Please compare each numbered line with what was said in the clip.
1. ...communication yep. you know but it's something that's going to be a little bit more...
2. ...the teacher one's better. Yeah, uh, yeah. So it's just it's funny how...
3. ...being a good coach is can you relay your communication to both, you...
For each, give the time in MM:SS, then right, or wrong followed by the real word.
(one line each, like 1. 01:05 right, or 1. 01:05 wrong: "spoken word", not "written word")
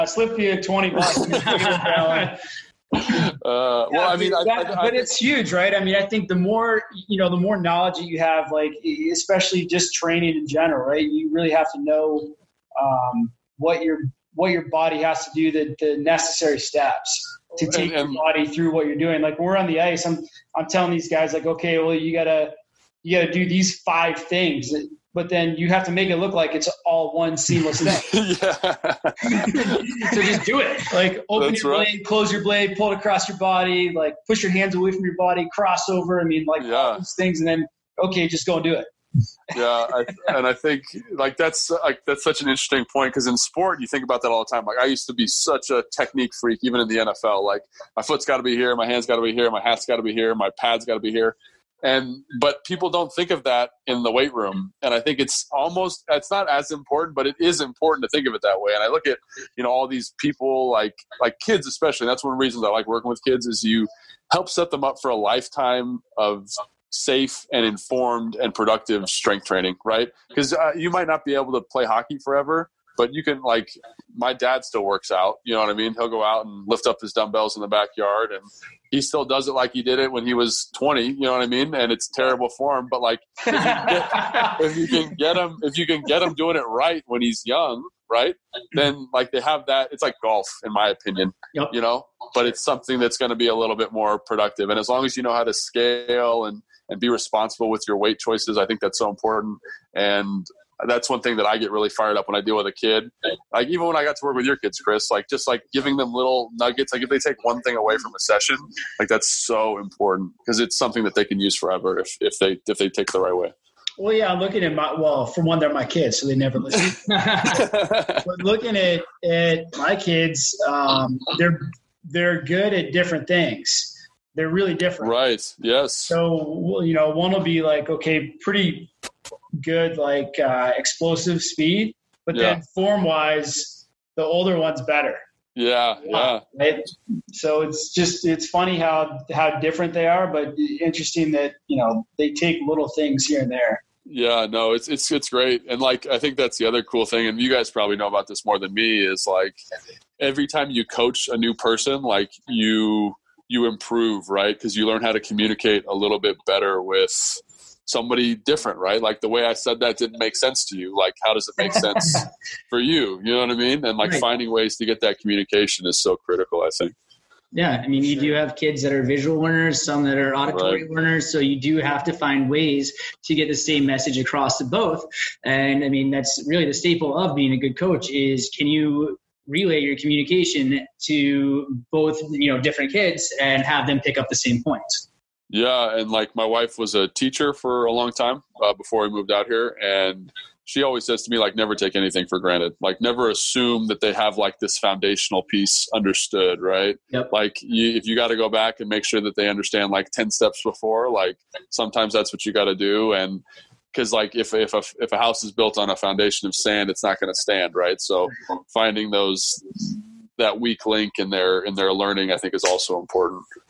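1. 01:30 wrong: "opinion", not "communication"
2. 02:14 wrong: "older", not "teacher"
3. 02:57 right.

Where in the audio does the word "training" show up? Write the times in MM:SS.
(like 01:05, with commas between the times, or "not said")
00:09, 01:09.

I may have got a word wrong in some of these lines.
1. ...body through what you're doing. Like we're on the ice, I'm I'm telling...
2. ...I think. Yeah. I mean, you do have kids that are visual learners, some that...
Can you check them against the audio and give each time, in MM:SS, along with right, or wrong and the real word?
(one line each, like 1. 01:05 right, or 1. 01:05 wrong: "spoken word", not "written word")
1. 00:18 right
2. 02:46 right.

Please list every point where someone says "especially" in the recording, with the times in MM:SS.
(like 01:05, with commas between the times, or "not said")
00:09, 01:01.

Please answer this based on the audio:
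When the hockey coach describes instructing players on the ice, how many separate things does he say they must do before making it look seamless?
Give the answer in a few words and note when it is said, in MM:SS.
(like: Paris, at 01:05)
5, at 00:23.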